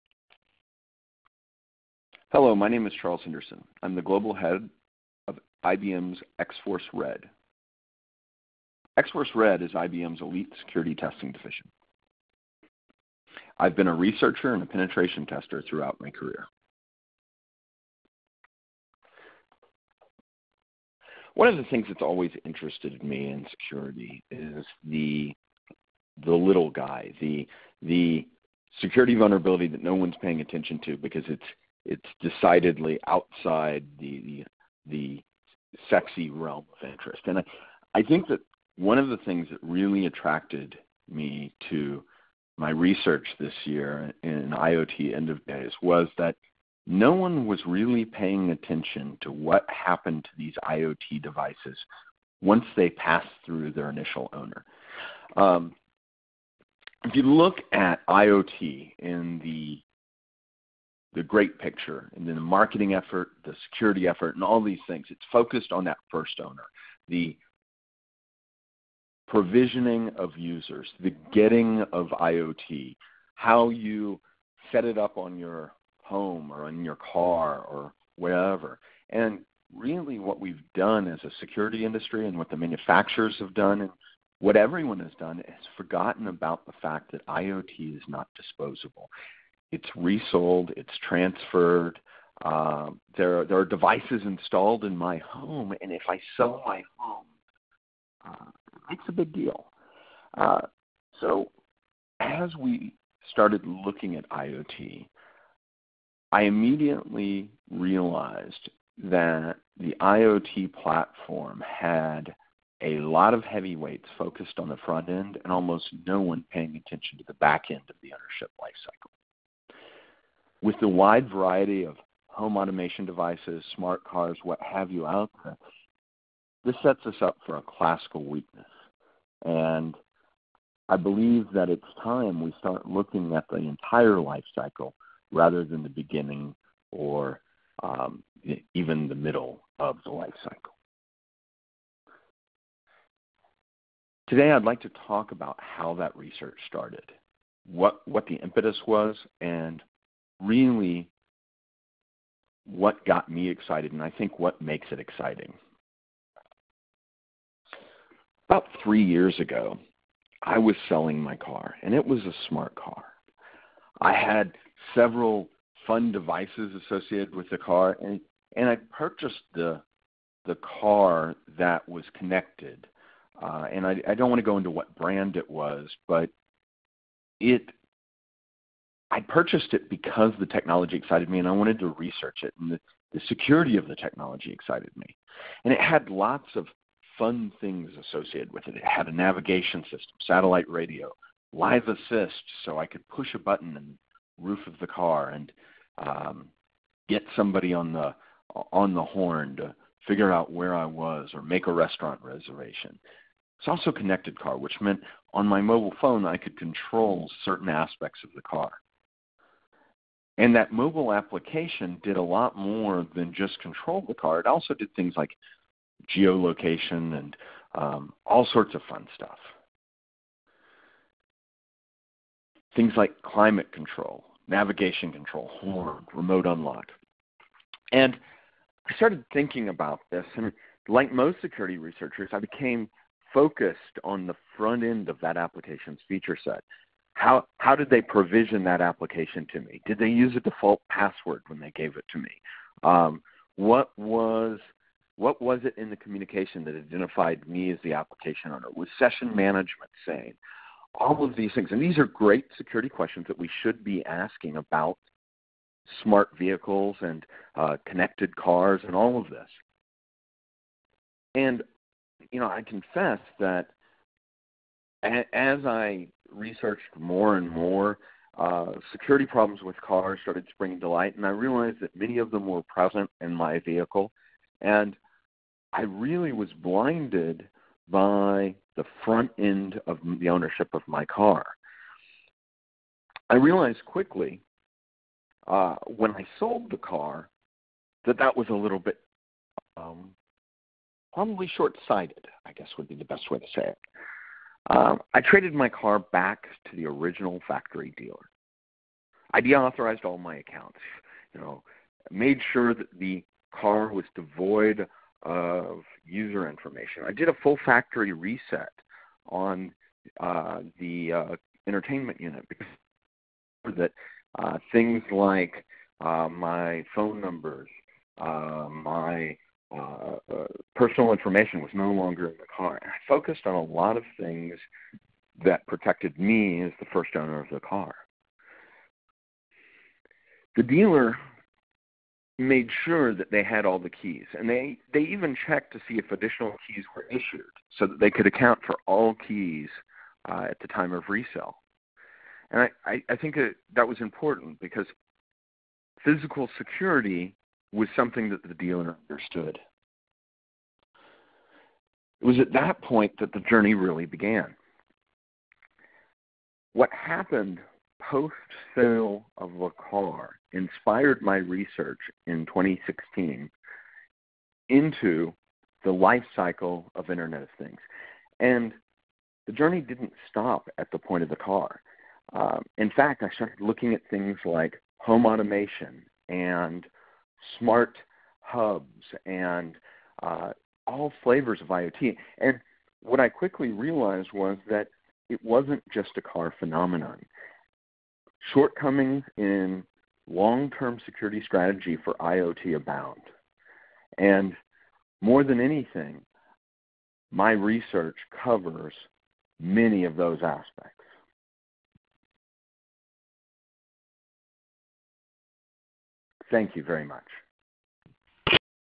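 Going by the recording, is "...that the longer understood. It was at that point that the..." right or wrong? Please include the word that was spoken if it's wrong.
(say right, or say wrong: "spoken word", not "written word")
wrong: "dealer", not "longer".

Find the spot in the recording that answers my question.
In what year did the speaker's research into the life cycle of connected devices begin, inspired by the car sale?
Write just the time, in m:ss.
6:02.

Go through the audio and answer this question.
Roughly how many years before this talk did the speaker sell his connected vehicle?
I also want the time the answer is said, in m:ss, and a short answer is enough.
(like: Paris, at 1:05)
3, at 2:38.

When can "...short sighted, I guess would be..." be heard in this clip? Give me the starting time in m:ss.
4:51.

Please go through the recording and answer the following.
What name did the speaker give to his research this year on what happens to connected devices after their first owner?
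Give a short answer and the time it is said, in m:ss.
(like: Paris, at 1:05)
IoT end of days, at 0:44.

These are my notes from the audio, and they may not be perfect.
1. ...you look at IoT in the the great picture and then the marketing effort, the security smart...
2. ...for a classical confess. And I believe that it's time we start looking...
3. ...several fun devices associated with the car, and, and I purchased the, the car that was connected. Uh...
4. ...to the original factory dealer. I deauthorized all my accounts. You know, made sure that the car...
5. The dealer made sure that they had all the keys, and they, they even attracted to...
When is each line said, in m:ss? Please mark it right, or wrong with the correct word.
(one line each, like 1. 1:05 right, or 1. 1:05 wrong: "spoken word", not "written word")
1. 0:57 wrong: "effort", not "smart"
2. 2:07 wrong: "weakness", not "confess"
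3. 2:44 right
4. 4:56 right
5. 5:30 wrong: "checked", not "attracted".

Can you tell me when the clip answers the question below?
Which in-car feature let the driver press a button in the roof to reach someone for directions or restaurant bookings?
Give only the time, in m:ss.
3:11.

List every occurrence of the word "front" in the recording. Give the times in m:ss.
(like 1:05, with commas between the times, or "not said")
1:54, 3:54, 4:39.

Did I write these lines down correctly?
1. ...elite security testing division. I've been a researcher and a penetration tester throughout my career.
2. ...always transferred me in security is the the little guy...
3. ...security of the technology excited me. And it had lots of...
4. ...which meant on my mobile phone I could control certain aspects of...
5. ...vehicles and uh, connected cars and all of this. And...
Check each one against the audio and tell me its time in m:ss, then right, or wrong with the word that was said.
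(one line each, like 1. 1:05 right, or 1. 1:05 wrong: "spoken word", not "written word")
1. 0:10 right
2. 0:22 wrong: "interested", not "transferred"
3. 3:03 right
4. 3:24 right
5. 4:16 right.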